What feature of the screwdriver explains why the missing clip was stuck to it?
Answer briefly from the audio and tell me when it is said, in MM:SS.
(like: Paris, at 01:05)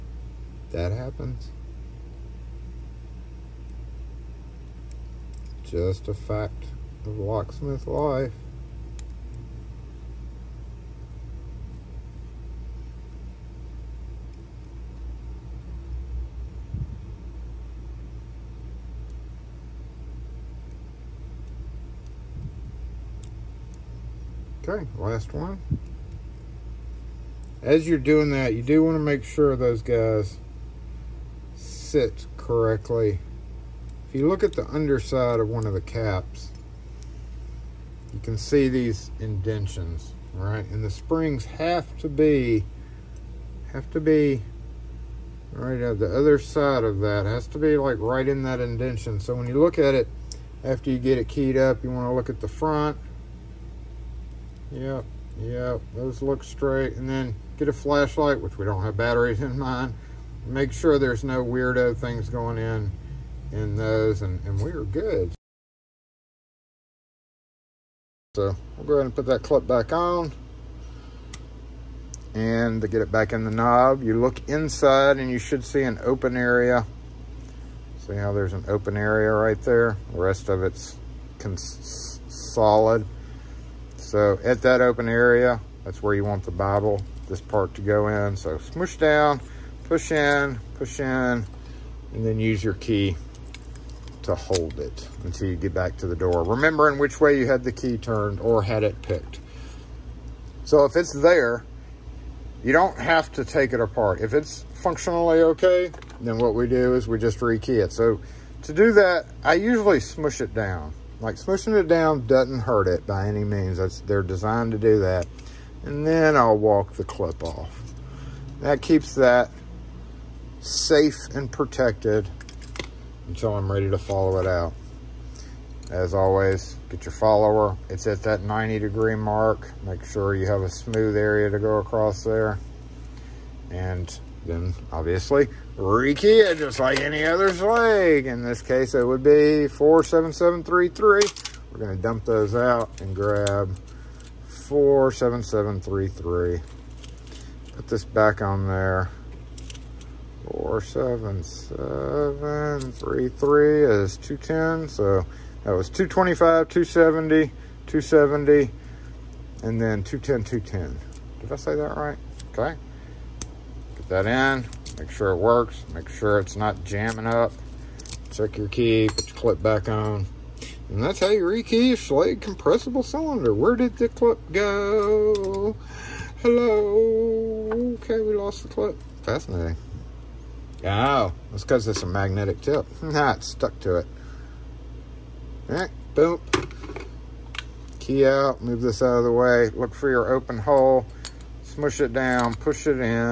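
magnetic tip, at 03:02.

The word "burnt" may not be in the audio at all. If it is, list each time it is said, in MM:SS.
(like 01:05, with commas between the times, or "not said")
not said.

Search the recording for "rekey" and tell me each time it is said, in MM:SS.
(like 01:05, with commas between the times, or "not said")
01:47, 02:51.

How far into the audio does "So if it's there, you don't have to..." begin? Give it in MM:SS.
01:40.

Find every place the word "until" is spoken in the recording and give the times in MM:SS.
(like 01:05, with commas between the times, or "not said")
01:35, 02:03.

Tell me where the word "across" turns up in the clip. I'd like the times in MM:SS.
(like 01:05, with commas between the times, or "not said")
02:11.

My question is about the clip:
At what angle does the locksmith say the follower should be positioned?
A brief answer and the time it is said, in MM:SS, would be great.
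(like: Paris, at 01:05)
90 degrees, at 02:08.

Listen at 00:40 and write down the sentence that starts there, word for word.
And the springs have to be, have to be right at the other side of that.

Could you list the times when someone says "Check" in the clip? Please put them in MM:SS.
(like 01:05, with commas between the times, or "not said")
02:48.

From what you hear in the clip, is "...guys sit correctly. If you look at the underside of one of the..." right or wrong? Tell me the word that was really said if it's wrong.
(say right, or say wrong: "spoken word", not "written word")
right.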